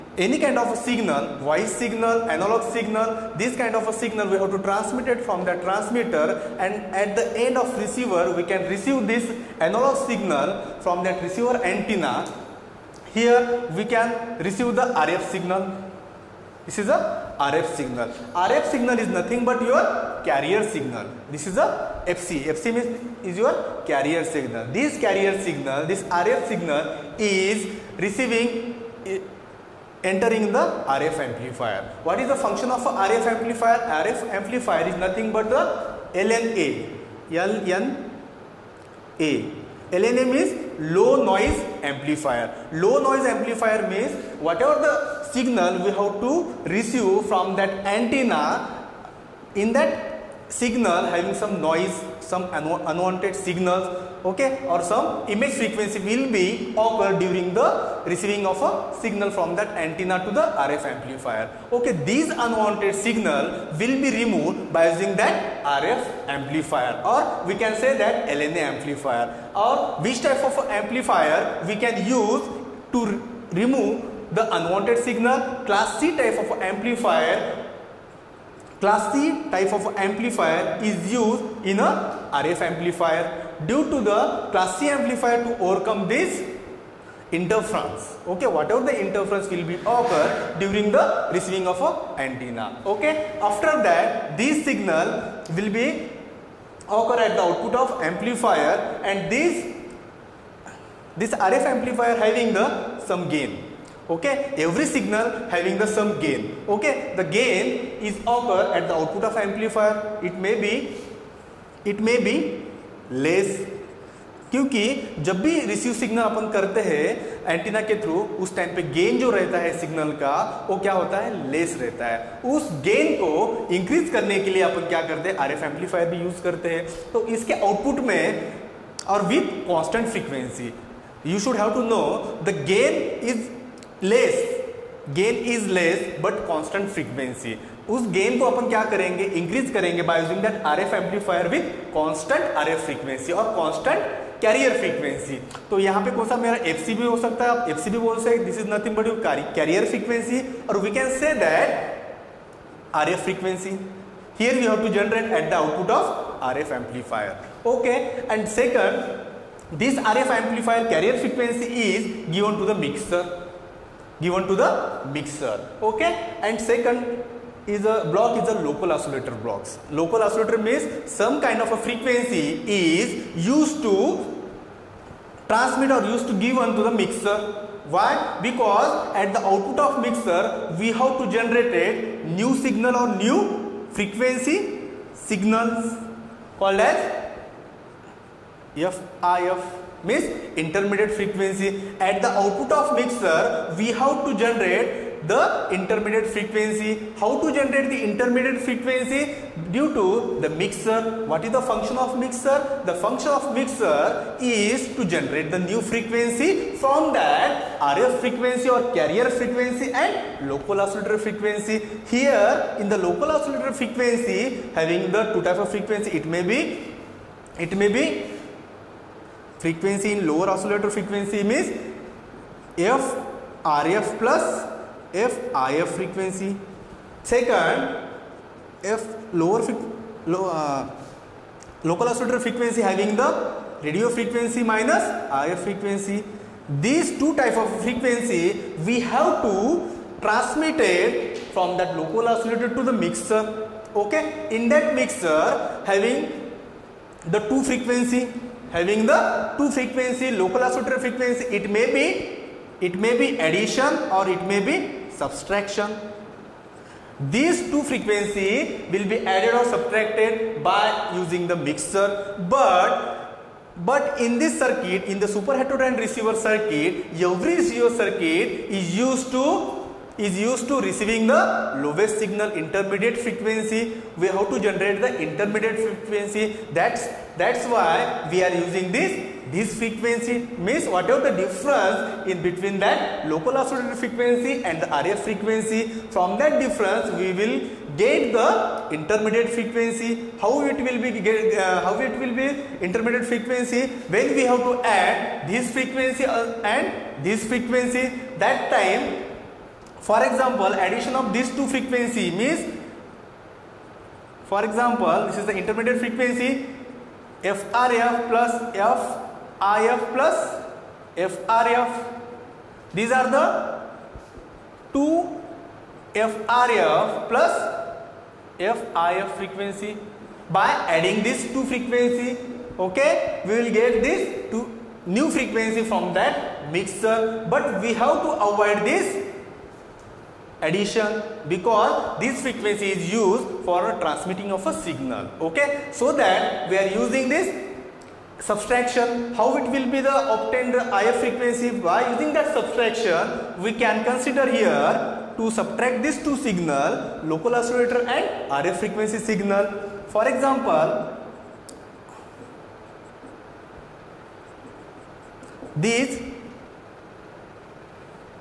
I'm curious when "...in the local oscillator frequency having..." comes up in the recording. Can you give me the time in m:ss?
3:32.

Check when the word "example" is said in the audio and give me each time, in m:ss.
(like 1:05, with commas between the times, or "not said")
5:00, 5:04, 5:50.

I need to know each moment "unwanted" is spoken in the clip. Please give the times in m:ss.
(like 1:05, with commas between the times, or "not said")
0:52, 1:02, 1:14.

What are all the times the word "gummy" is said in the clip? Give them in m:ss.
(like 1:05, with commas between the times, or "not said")
not said.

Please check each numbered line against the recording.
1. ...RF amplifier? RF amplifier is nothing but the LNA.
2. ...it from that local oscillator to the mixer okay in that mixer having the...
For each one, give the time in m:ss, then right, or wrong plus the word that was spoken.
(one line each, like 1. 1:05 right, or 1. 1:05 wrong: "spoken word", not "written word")
1. 0:33 right
2. 4:00 right.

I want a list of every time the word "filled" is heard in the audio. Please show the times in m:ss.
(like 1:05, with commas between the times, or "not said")
not said.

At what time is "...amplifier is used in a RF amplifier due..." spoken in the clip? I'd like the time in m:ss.
1:19.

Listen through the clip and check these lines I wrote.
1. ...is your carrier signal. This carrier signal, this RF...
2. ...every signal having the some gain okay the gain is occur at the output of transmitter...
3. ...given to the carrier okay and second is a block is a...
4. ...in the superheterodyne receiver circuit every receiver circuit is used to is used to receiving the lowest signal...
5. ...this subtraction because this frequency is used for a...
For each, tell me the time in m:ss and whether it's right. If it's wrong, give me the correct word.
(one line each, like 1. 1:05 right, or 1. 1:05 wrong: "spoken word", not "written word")
1. 0:23 right
2. 1:44 wrong: "amplifier", not "transmitter"
3. 2:44 wrong: "mixer", not "carrier"
4. 4:25 right
5. 5:28 wrong: "addition", not "subtraction".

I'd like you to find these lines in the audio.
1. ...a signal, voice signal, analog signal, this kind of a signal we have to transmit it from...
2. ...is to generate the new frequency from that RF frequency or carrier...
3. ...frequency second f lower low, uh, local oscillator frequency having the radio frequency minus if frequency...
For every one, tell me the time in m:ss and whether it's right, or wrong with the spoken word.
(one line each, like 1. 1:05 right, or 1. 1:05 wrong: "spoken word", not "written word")
1. 0:00 right
2. 3:24 right
3. 3:45 right.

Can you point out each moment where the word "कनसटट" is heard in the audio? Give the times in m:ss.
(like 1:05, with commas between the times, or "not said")
2:16, 2:23.